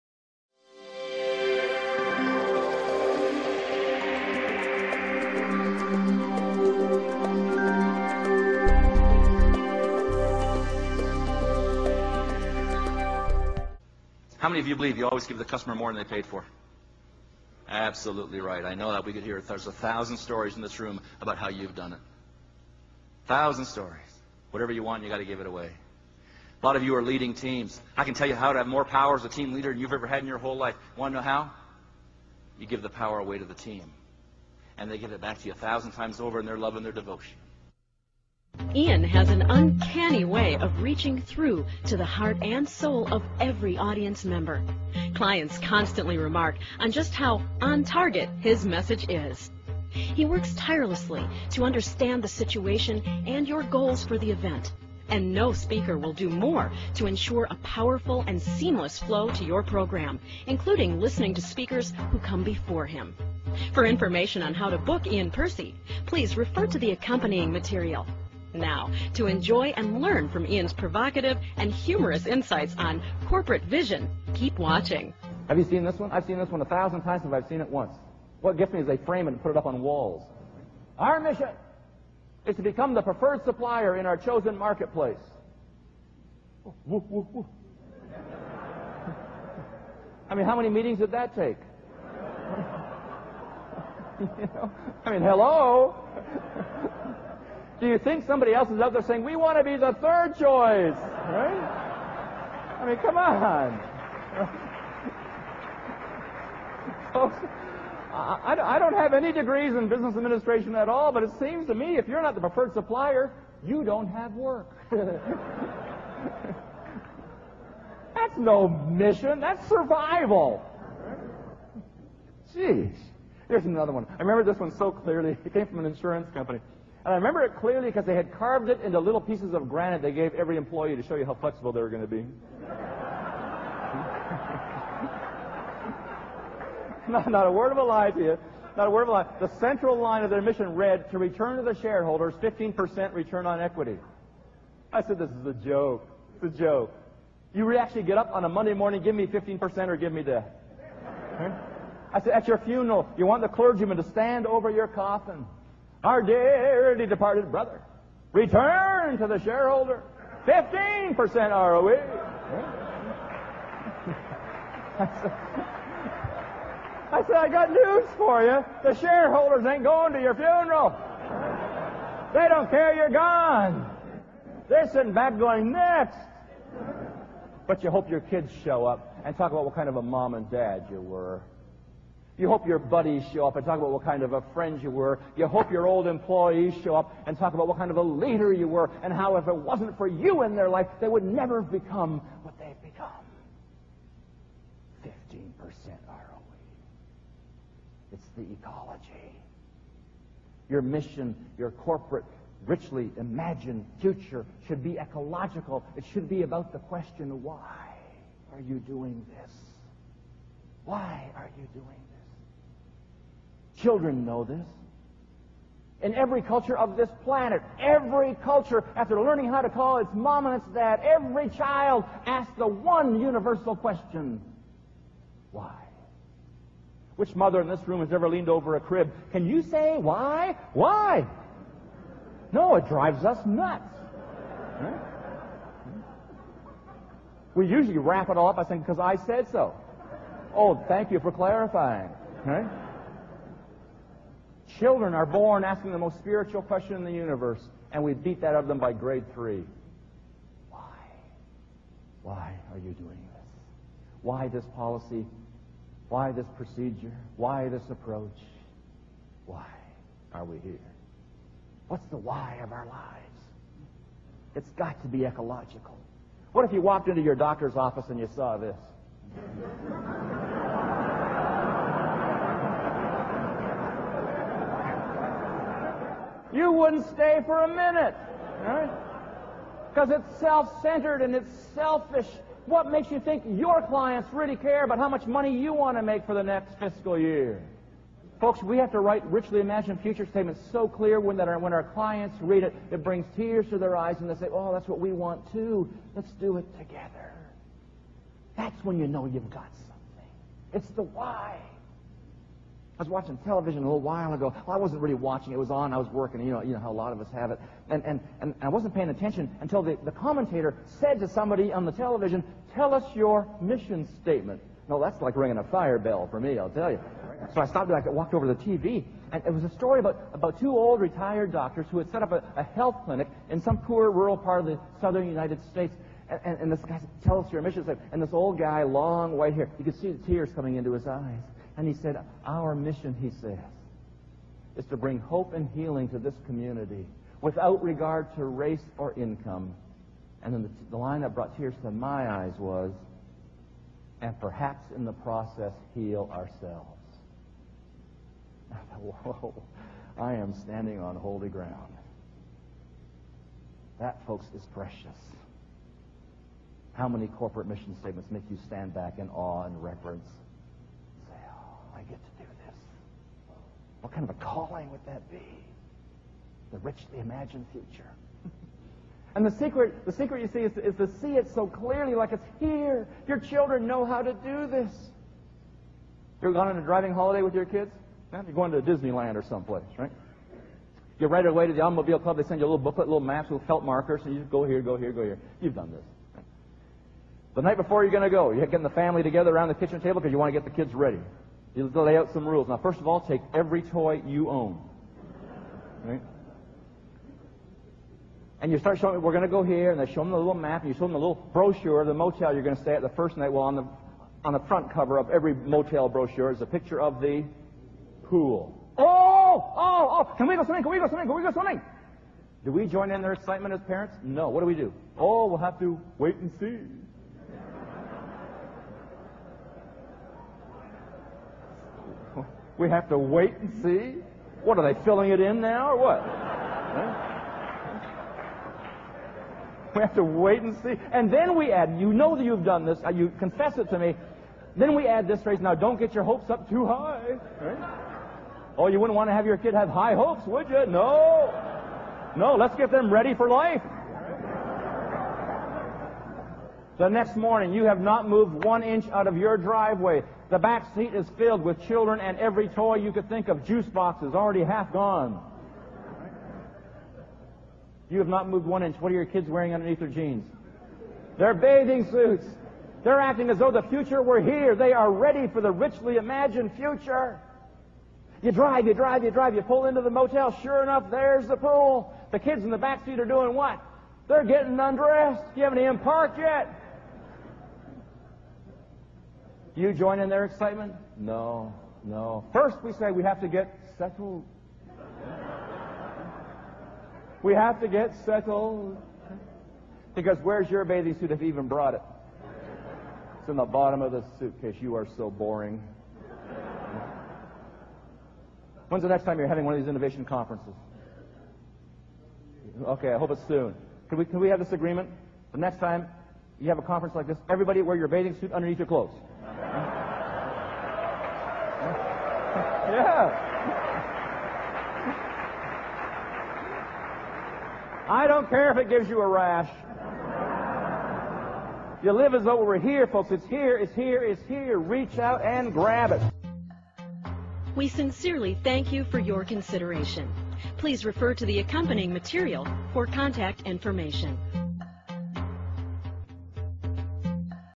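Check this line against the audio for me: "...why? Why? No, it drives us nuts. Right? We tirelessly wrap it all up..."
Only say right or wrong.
wrong.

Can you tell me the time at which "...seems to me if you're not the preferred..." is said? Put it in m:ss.
1:51.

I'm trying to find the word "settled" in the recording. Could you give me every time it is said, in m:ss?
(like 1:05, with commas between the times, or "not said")
8:03, 8:08.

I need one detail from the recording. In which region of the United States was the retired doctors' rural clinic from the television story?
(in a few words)
southern United States.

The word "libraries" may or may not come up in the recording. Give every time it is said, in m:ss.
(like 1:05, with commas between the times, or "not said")
not said.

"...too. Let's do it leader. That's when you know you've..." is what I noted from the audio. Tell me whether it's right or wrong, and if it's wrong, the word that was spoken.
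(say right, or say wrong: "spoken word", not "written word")
wrong: "together", not "leader".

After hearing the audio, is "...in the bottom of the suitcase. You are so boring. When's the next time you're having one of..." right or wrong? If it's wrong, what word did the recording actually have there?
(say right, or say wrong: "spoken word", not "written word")
right.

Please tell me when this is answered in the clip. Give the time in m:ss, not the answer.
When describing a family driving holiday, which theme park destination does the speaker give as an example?
6:18.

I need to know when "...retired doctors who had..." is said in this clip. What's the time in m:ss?
5:21.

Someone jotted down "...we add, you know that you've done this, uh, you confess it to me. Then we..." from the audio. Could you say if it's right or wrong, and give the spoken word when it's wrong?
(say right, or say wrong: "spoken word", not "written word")
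right.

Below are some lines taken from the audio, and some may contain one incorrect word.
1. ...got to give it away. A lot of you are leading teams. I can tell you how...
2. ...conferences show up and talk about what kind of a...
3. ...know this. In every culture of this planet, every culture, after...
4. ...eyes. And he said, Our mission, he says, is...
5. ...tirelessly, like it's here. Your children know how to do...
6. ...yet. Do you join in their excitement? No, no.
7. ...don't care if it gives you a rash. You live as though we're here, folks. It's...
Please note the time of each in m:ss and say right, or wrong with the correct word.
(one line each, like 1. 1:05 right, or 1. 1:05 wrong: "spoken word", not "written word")
1. 0:25 right
2. 3:02 wrong: "buddies", not "conferences"
3. 3:34 right
4. 5:31 right
5. 6:11 wrong: "clearly", not "tirelessly"
6. 7:56 right
7. 8:38 right.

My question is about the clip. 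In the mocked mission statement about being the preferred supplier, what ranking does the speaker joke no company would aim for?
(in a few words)
third choice.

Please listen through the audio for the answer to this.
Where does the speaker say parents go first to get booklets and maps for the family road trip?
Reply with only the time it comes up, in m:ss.
6:21.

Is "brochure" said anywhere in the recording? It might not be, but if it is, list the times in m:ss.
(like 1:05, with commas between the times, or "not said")
6:41, 6:46.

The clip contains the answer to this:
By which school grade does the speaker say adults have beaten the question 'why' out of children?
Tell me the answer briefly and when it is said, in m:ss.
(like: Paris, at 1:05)
grade three, at 4:08.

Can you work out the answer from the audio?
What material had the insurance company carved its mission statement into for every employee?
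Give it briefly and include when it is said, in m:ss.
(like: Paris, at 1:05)
granite, at 2:09.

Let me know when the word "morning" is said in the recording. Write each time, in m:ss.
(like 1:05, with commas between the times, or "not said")
2:28, 7:27.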